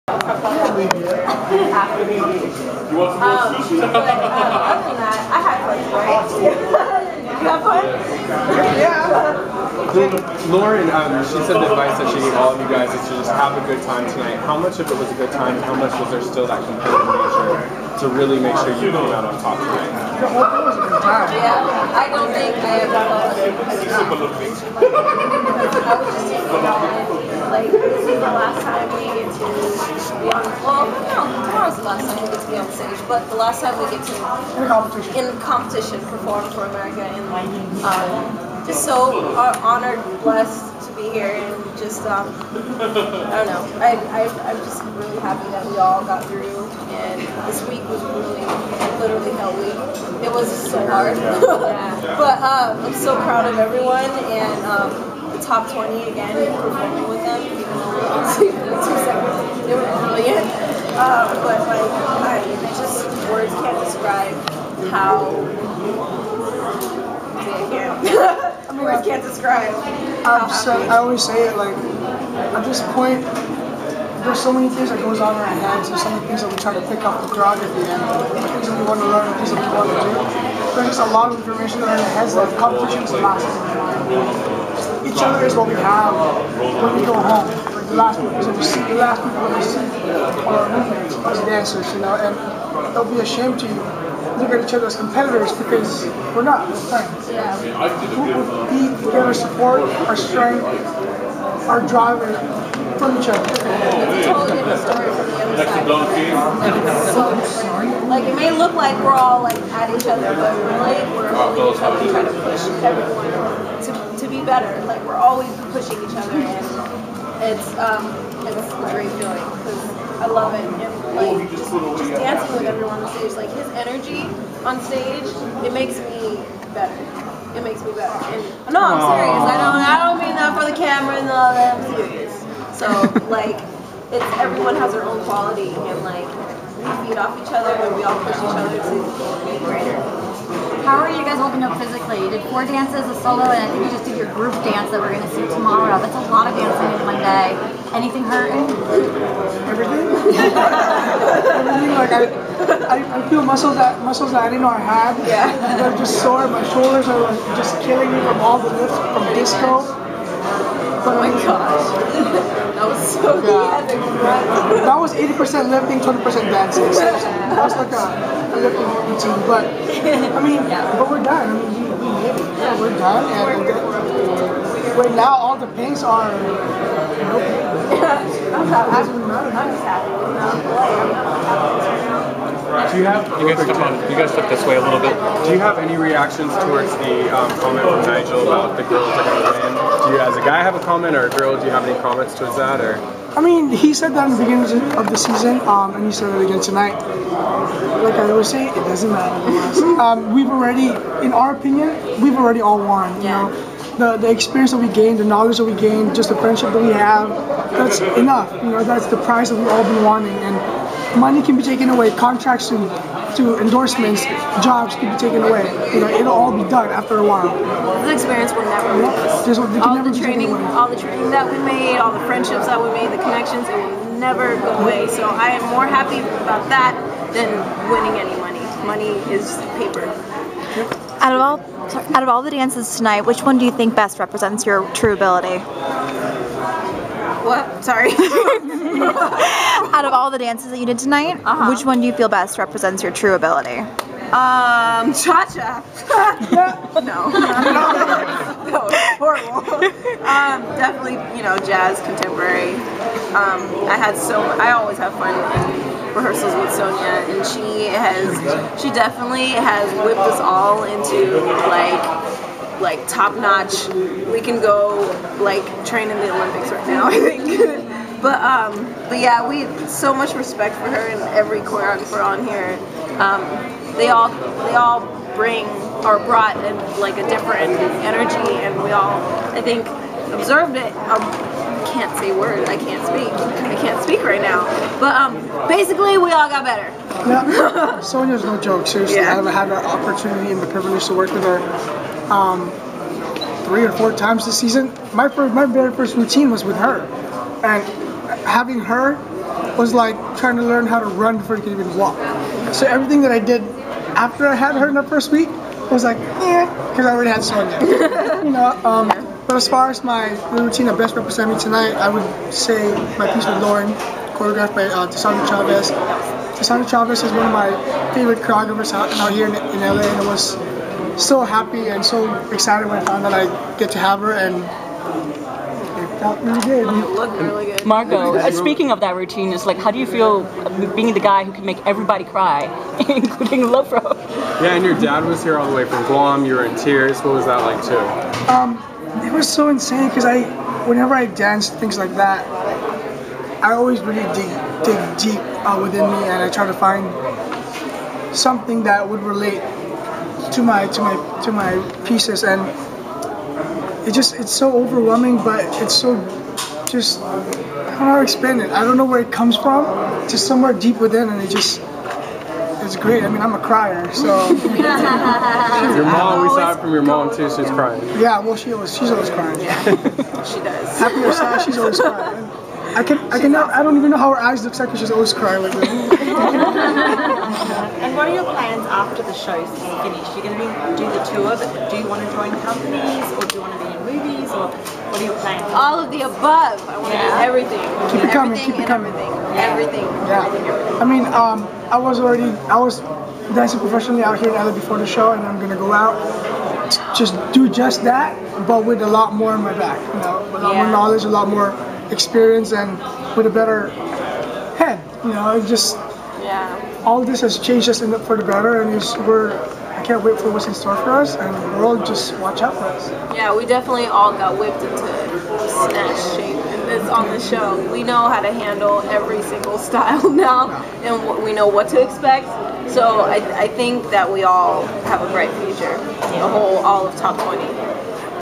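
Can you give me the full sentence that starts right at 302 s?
So everything that I did after I had her in the first week was like, yeah, because I already had Sonia.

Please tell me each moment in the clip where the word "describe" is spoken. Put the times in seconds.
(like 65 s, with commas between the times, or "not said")
63 s, 69 s.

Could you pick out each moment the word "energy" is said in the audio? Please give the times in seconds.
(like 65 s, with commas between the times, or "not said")
123 s, 278 s.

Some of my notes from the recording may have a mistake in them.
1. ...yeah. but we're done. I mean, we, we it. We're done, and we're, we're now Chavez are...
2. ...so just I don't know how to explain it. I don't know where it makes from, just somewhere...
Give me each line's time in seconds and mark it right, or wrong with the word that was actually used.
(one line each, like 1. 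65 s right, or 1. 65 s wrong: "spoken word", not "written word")
1. 170 s wrong: "Things", not "Chavez"
2. 355 s wrong: "comes", not "makes".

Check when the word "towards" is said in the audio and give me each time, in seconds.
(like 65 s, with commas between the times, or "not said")
186 s, 192 s.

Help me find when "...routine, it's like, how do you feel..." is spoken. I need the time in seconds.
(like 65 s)
329 s.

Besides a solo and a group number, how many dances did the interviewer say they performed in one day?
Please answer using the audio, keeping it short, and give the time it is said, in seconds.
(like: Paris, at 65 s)
4, at 142 s.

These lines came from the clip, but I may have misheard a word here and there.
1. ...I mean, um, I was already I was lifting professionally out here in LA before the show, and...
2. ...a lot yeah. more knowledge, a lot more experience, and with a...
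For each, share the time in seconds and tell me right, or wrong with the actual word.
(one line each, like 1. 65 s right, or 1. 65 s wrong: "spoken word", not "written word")
1. 391 s wrong: "dancing", not "lifting"
2. 400 s right.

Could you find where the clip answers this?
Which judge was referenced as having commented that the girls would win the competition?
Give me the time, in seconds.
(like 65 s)
188 s.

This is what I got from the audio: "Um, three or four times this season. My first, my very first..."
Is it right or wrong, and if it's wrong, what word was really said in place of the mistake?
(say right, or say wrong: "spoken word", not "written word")
right.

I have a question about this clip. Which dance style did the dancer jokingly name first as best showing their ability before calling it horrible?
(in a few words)
Cha cha.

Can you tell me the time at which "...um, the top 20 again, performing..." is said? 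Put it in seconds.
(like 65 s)
54 s.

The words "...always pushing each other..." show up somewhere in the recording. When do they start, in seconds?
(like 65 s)
115 s.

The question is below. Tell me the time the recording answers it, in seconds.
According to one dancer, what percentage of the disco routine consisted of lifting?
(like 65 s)
165 s.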